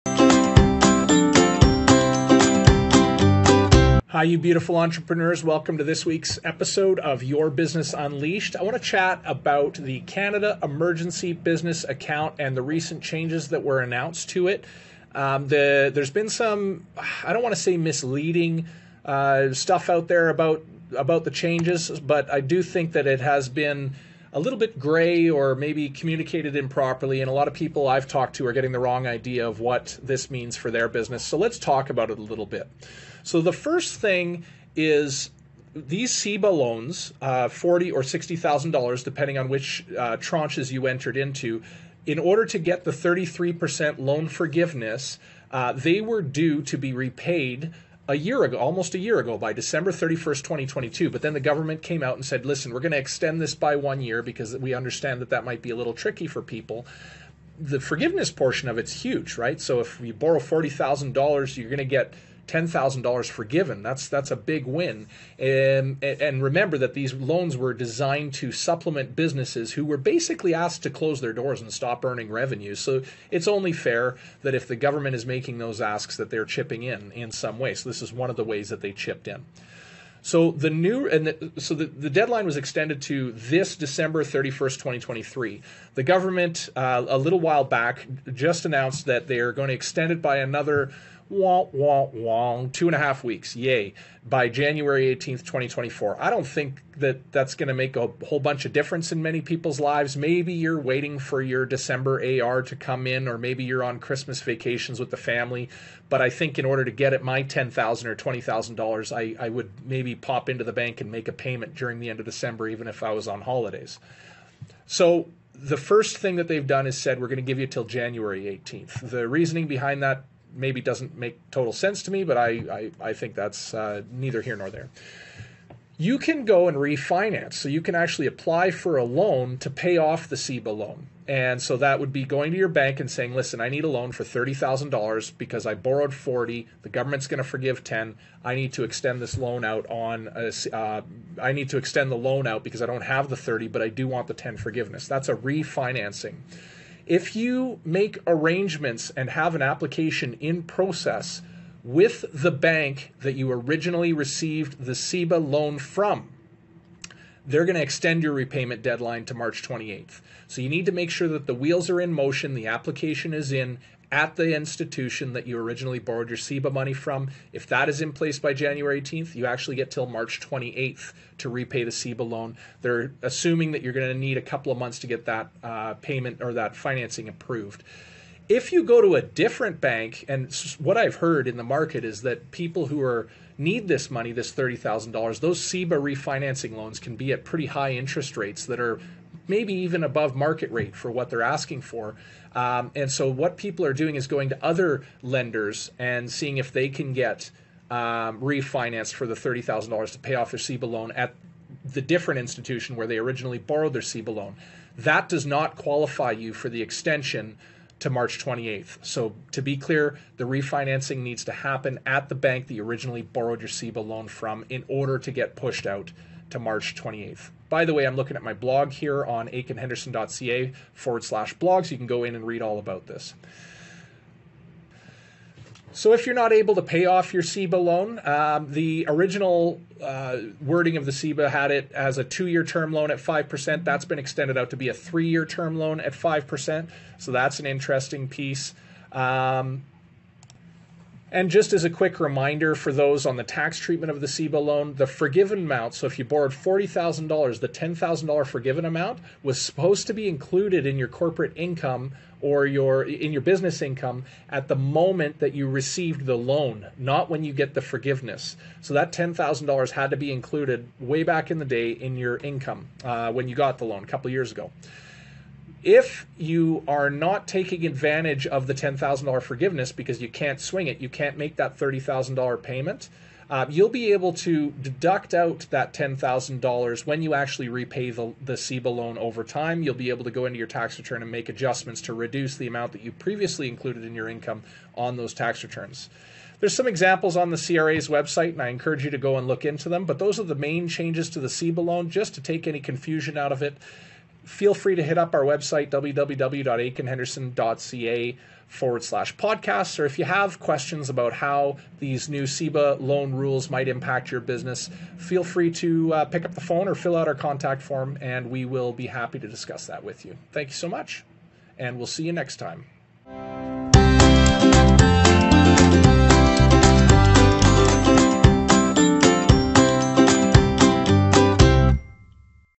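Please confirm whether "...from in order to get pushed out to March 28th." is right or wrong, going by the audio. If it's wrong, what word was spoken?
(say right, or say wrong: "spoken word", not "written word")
right.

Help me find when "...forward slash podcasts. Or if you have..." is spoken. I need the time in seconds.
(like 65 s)
298 s.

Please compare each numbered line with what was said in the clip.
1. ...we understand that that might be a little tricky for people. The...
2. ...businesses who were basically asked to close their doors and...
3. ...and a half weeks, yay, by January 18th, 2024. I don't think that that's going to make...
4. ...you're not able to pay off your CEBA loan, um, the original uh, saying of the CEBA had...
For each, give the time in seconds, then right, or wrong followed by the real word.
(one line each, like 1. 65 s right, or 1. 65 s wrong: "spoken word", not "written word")
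1. 54 s right
2. 69 s right
3. 92 s right
4. 226 s wrong: "wording", not "saying".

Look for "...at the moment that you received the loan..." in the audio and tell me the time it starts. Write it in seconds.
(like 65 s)
254 s.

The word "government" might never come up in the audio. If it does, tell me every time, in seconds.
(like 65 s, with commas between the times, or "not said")
51 s, 74 s, 86 s, 136 s.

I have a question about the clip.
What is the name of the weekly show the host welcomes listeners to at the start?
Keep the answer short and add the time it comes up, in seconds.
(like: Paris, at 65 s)
Your Business Unleashed, at 7 s.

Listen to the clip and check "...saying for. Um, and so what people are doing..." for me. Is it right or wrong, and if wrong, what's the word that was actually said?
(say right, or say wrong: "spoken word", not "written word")
wrong: "asking", not "saying".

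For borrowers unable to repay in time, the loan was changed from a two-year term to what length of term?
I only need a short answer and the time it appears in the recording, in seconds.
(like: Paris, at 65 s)
3 years, at 234 s.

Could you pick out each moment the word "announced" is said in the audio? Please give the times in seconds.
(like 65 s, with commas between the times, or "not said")
13 s, 88 s.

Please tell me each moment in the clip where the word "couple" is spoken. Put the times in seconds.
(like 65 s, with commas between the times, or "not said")
174 s, 264 s.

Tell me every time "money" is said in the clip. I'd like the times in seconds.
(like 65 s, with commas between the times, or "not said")
166 s, 184 s.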